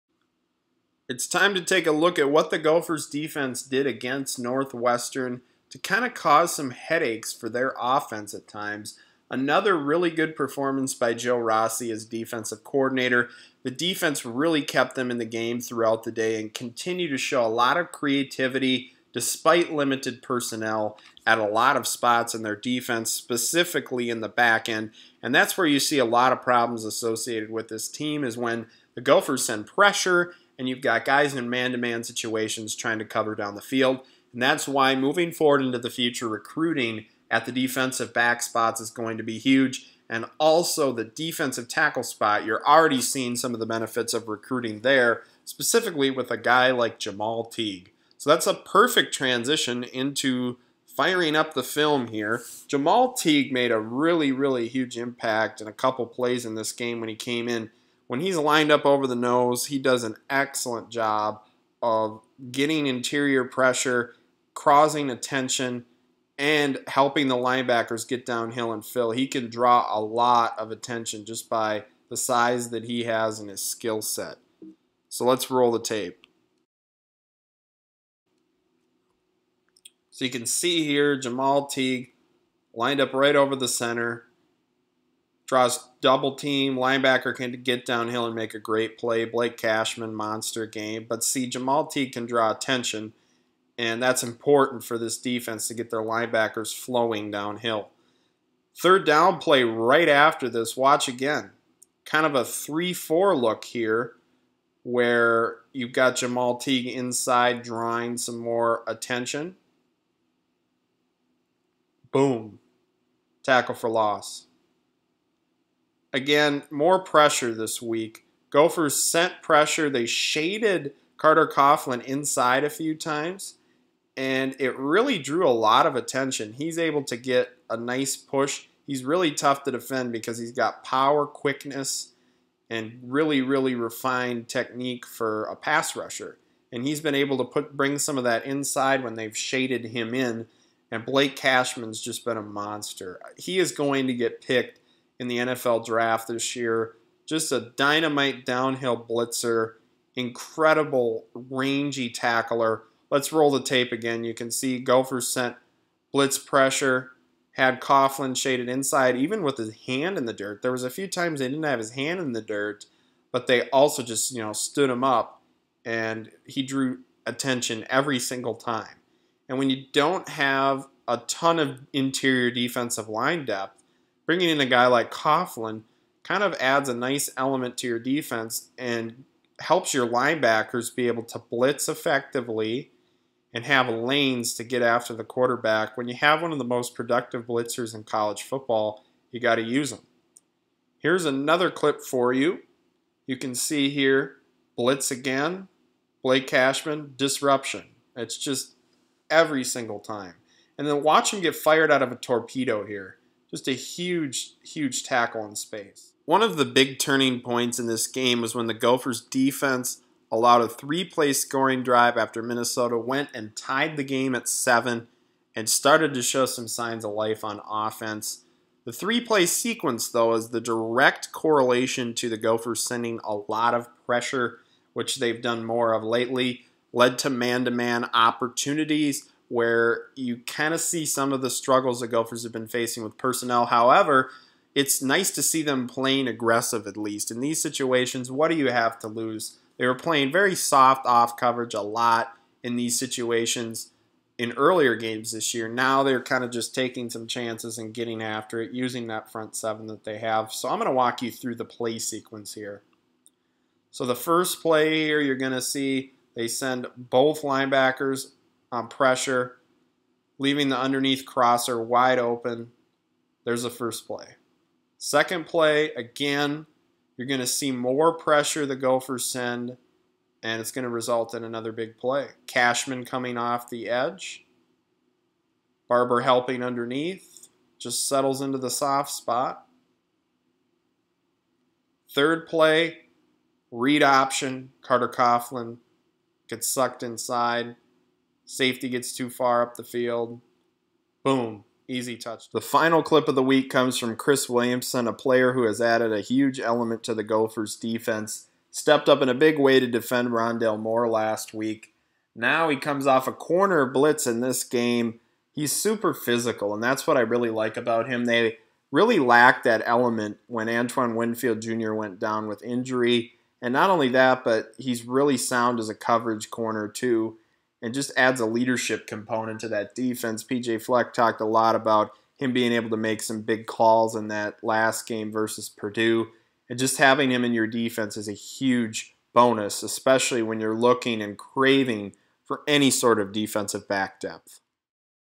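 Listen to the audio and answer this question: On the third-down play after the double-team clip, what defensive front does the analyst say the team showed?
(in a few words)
3 4 look.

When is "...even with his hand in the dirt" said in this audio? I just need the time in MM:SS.
02:39.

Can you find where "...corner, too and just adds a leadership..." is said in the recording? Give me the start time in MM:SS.
05:16.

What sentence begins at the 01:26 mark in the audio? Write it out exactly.
Linebacker can get downhill and make a great play.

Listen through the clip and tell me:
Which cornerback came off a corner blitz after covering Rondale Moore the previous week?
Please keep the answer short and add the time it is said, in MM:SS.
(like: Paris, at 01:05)
Chris Williamson, at 04:54.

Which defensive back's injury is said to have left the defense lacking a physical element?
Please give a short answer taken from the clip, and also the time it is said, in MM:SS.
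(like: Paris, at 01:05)
Antoine Winfield Jr., at 05:10.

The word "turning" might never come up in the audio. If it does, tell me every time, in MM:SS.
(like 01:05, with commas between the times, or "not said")
03:26.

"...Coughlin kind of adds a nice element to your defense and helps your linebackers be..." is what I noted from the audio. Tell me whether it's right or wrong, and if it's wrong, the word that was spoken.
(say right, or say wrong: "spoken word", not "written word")
right.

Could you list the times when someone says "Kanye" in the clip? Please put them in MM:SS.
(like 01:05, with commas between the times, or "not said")
not said.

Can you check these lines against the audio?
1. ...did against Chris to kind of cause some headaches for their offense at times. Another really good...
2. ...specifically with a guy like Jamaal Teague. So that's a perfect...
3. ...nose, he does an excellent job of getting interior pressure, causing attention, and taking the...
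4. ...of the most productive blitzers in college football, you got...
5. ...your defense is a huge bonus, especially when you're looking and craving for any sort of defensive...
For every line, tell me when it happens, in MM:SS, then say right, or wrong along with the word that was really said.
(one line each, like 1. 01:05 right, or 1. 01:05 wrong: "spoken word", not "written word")
1. 00:03 wrong: "Northwestern", not "Chris"
2. 00:45 right
3. 00:59 wrong: "helping", not "taking"
4. 03:06 right
5. 05:27 right.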